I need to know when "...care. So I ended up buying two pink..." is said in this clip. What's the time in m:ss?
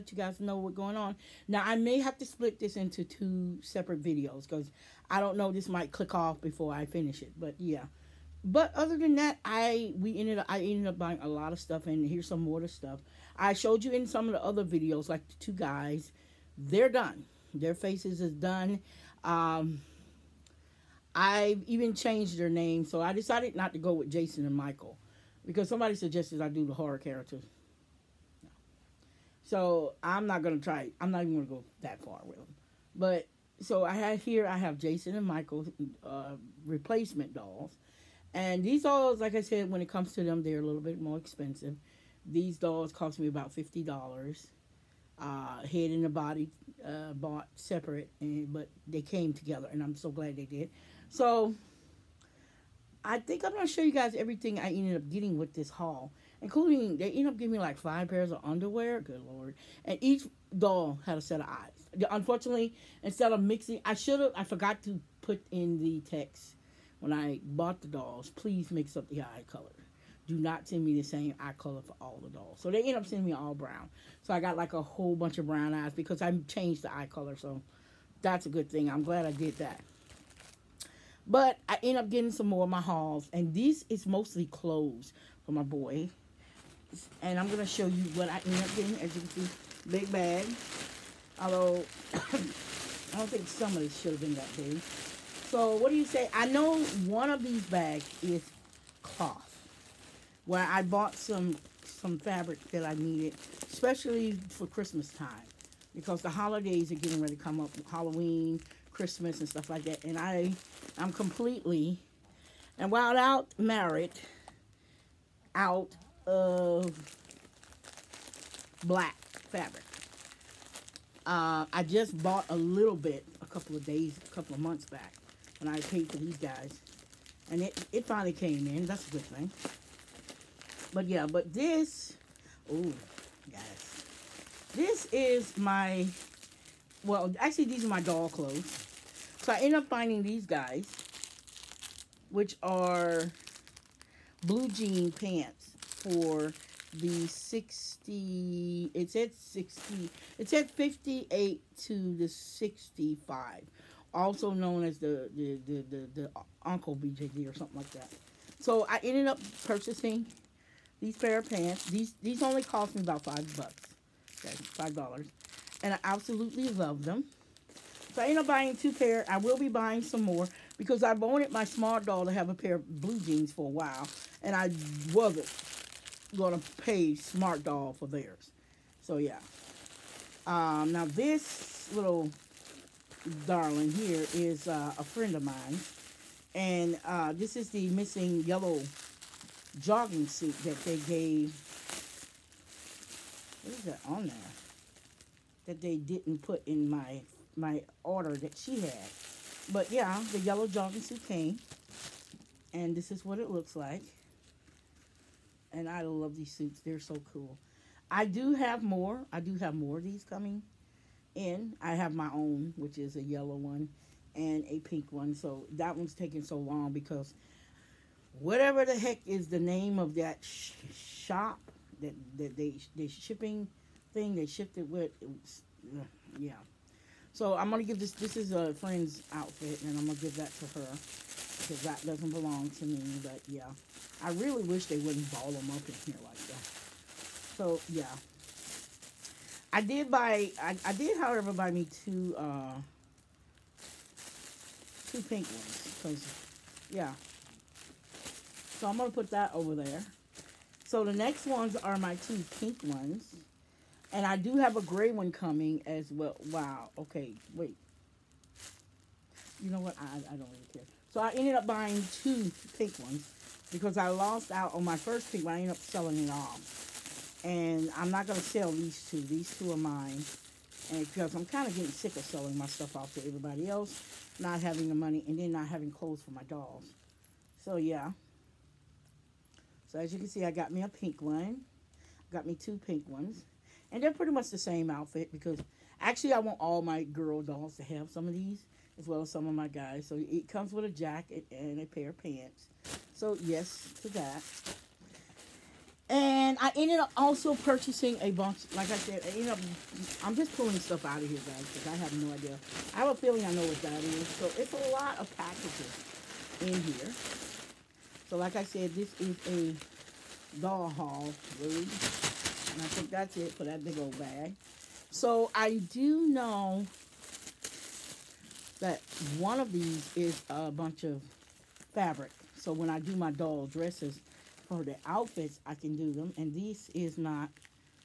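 4:20.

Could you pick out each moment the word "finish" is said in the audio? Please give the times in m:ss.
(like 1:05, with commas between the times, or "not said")
0:06.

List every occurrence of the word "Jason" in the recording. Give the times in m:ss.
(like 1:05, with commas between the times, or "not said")
0:24, 0:34.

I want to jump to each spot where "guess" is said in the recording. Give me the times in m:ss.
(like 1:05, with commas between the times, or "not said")
not said.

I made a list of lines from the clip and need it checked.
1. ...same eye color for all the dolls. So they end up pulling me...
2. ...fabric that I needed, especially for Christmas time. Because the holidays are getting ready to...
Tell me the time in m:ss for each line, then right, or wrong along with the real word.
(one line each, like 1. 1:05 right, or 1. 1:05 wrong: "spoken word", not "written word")
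1. 1:11 wrong: "sending", not "pulling"
2. 1:42 right.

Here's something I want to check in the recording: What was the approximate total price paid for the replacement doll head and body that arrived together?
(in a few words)
$50.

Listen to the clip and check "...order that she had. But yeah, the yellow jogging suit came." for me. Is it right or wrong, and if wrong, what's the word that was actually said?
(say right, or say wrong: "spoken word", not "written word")
right.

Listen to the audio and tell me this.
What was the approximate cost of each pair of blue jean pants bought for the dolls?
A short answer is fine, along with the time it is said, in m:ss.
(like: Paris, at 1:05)
$5, at 2:43.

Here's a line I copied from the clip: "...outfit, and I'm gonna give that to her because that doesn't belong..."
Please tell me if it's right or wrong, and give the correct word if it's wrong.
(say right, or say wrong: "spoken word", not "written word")
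right.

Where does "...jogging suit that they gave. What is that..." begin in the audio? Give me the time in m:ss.
3:09.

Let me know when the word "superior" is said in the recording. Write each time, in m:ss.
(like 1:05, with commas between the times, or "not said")
not said.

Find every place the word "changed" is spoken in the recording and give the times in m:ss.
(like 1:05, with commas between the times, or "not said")
0:21, 1:16.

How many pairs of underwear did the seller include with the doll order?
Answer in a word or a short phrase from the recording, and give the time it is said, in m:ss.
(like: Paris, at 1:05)
5, at 0:57.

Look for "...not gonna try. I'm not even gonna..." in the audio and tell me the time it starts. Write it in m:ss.
0:30.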